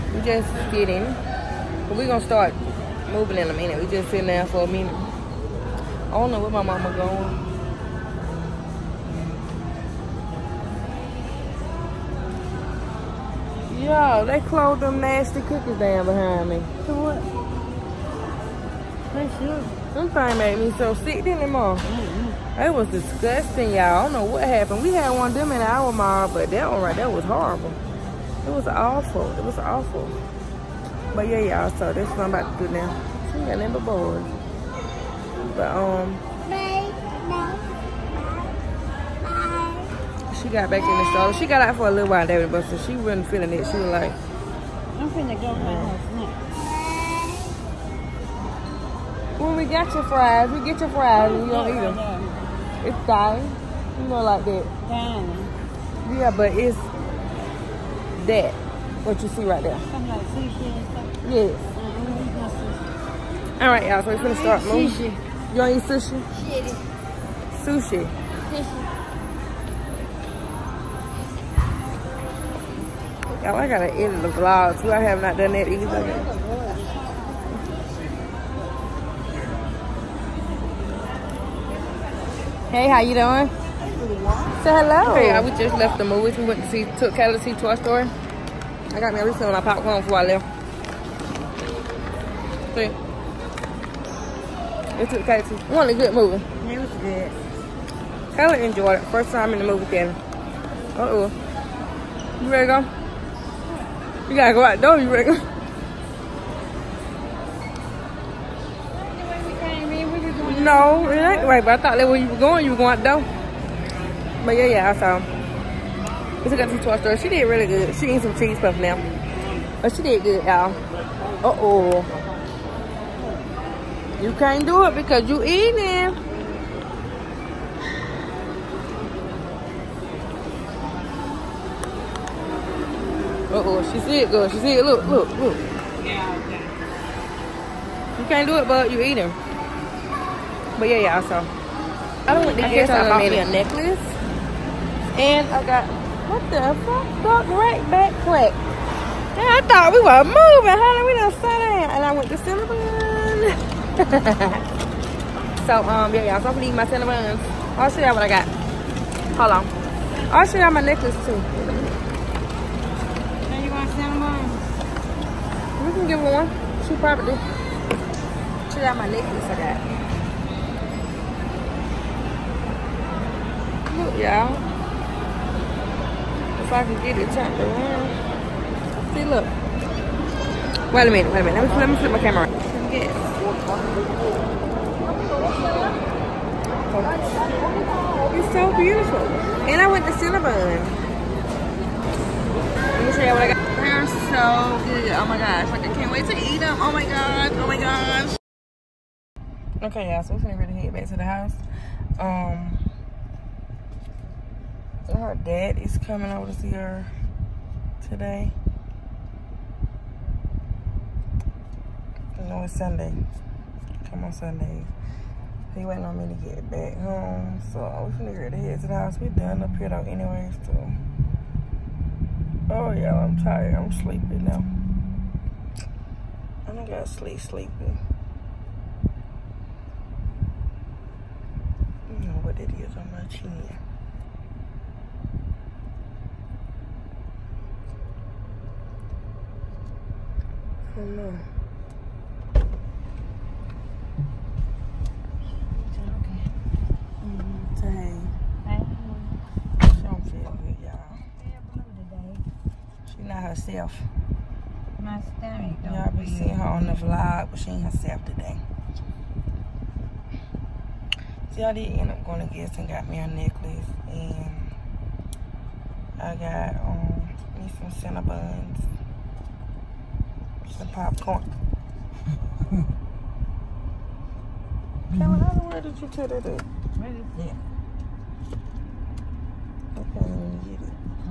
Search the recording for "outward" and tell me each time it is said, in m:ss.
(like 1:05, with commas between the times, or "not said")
not said.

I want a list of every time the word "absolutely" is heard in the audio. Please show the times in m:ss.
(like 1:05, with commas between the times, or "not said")
not said.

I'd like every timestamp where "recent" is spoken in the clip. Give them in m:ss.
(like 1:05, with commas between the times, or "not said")
1:29.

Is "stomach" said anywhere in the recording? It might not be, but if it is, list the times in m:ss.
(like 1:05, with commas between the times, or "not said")
4:15.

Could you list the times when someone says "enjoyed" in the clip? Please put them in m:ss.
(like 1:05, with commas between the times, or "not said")
1:38.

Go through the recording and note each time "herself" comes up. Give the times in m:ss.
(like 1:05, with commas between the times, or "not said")
4:13, 4:17.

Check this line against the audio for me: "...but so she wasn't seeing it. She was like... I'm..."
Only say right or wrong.
wrong.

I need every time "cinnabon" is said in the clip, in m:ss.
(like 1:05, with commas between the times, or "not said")
2:32, 2:36, 2:43, 3:10, 4:27.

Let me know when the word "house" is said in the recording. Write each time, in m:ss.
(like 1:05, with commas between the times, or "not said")
3:21, 3:38.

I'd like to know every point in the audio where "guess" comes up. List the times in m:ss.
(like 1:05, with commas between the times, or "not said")
2:22, 4:22.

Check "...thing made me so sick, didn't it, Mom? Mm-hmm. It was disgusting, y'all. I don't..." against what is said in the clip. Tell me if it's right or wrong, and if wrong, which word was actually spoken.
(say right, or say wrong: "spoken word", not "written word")
right.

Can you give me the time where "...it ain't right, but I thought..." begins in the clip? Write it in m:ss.
1:51.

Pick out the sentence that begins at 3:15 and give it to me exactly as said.
Like, I can't wait to eat them.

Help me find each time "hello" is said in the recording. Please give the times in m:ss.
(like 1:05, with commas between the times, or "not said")
1:24.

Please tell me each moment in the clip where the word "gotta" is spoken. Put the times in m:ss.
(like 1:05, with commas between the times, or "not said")
1:13, 1:44.